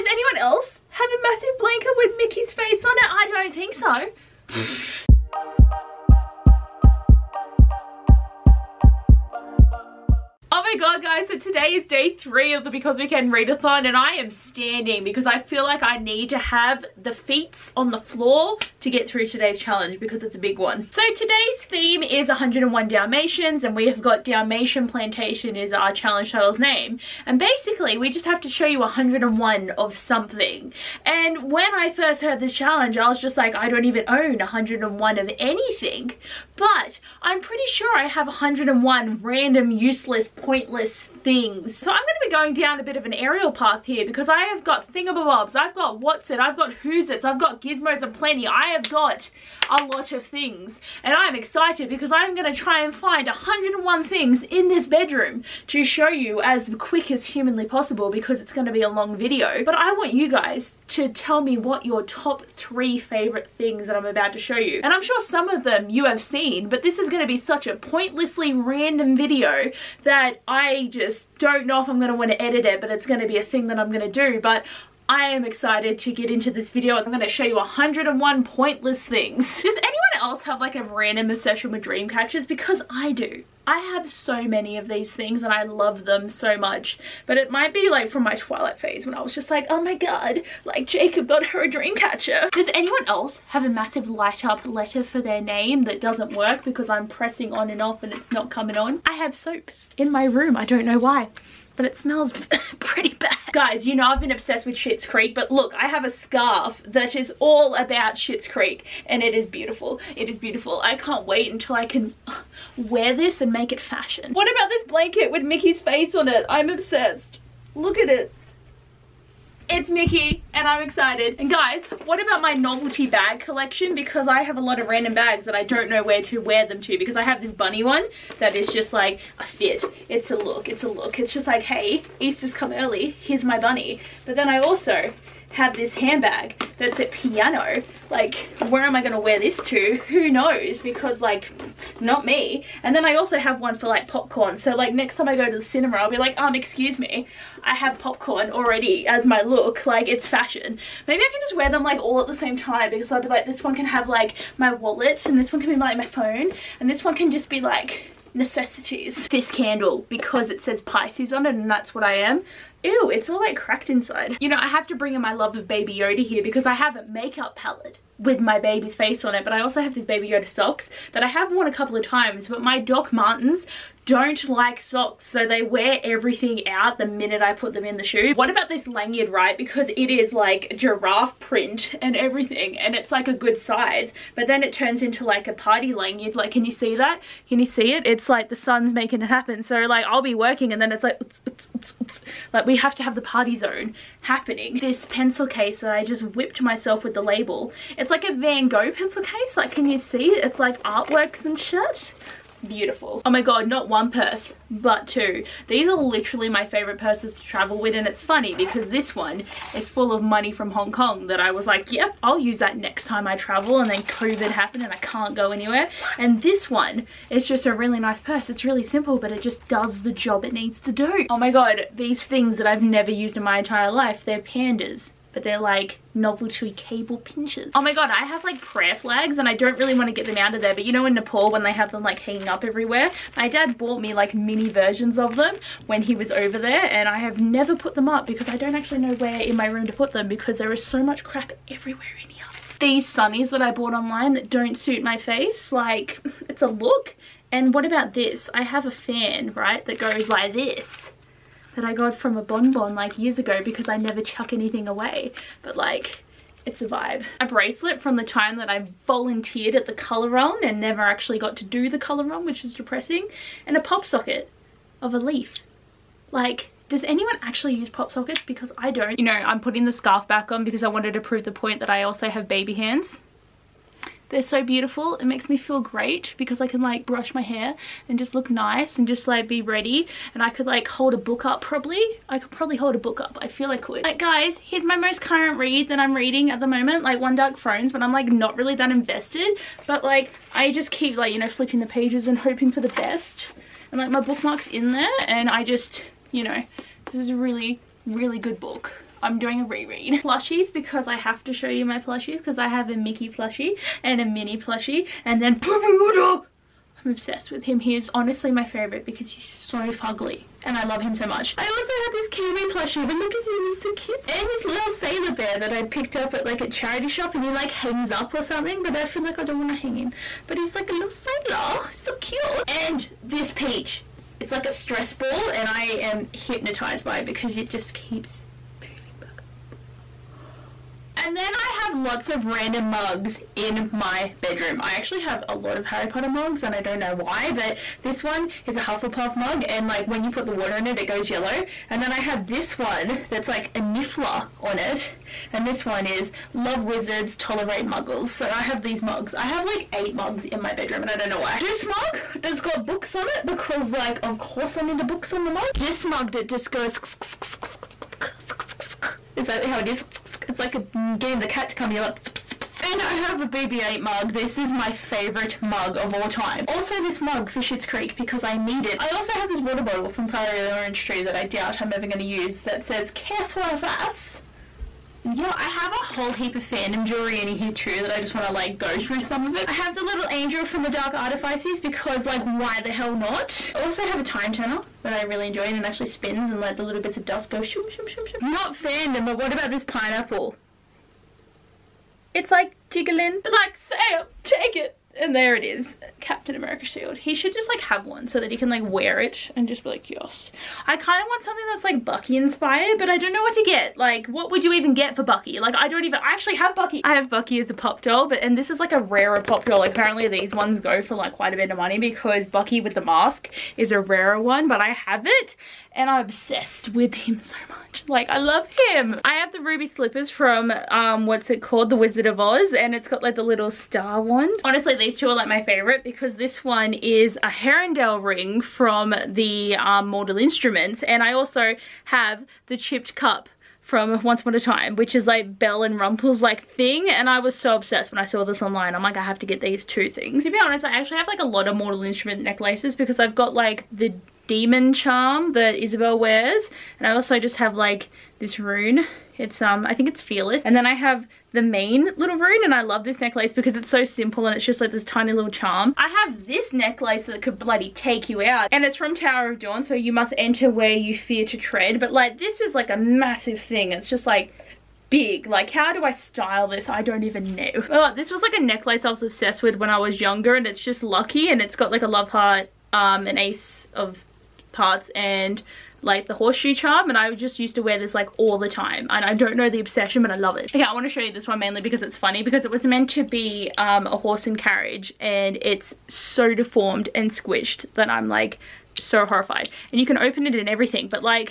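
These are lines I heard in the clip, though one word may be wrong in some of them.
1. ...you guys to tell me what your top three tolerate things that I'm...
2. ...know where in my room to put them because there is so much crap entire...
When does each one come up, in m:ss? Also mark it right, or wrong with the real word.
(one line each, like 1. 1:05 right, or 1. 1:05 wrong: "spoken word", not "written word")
1. 1:00 wrong: "favorite", not "tolerate"
2. 3:59 wrong: "everywhere", not "entire".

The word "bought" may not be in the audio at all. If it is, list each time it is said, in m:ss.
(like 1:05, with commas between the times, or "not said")
3:53, 4:03.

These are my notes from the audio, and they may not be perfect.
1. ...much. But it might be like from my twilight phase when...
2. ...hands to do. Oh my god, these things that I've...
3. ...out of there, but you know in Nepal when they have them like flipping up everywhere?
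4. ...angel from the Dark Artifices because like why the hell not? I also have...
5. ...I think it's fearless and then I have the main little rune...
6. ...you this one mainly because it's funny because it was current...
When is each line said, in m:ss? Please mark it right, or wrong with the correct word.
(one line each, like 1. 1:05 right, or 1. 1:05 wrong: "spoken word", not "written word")
1. 1:26 right
2. 3:40 wrong: "needs", not "hands"
3. 3:50 wrong: "hanging", not "flipping"
4. 6:20 right
5. 7:29 right
6. 8:01 wrong: "meant", not "current".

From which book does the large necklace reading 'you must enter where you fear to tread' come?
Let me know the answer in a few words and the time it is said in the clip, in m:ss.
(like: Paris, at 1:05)
Tower of Dawn, at 7:39.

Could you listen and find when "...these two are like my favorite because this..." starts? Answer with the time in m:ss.
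7:04.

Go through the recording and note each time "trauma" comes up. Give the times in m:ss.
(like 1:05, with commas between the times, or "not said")
not said.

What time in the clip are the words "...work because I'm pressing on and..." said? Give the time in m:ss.
1:36.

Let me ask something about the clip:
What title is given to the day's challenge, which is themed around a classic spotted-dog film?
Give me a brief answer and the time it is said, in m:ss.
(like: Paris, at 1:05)
Dalmatian Plantation, at 0:24.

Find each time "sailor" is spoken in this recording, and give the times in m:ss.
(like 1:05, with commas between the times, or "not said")
5:14, 5:21.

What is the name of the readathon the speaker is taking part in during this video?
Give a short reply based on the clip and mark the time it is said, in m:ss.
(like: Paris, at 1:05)
Because We Can Readathon, at 0:12.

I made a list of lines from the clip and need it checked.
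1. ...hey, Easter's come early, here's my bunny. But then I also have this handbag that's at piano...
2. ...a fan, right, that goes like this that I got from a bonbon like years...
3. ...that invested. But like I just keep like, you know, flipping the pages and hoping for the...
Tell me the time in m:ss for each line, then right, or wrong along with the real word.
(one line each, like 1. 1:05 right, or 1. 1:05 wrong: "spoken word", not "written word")
1. 2:11 right
2. 4:08 right
3. 4:48 right.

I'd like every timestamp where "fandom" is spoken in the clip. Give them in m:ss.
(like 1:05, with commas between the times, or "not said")
6:16, 6:28.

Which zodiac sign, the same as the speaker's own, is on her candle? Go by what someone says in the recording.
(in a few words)
Pisces.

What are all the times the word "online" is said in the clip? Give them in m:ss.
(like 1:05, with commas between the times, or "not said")
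4:03, 7:18.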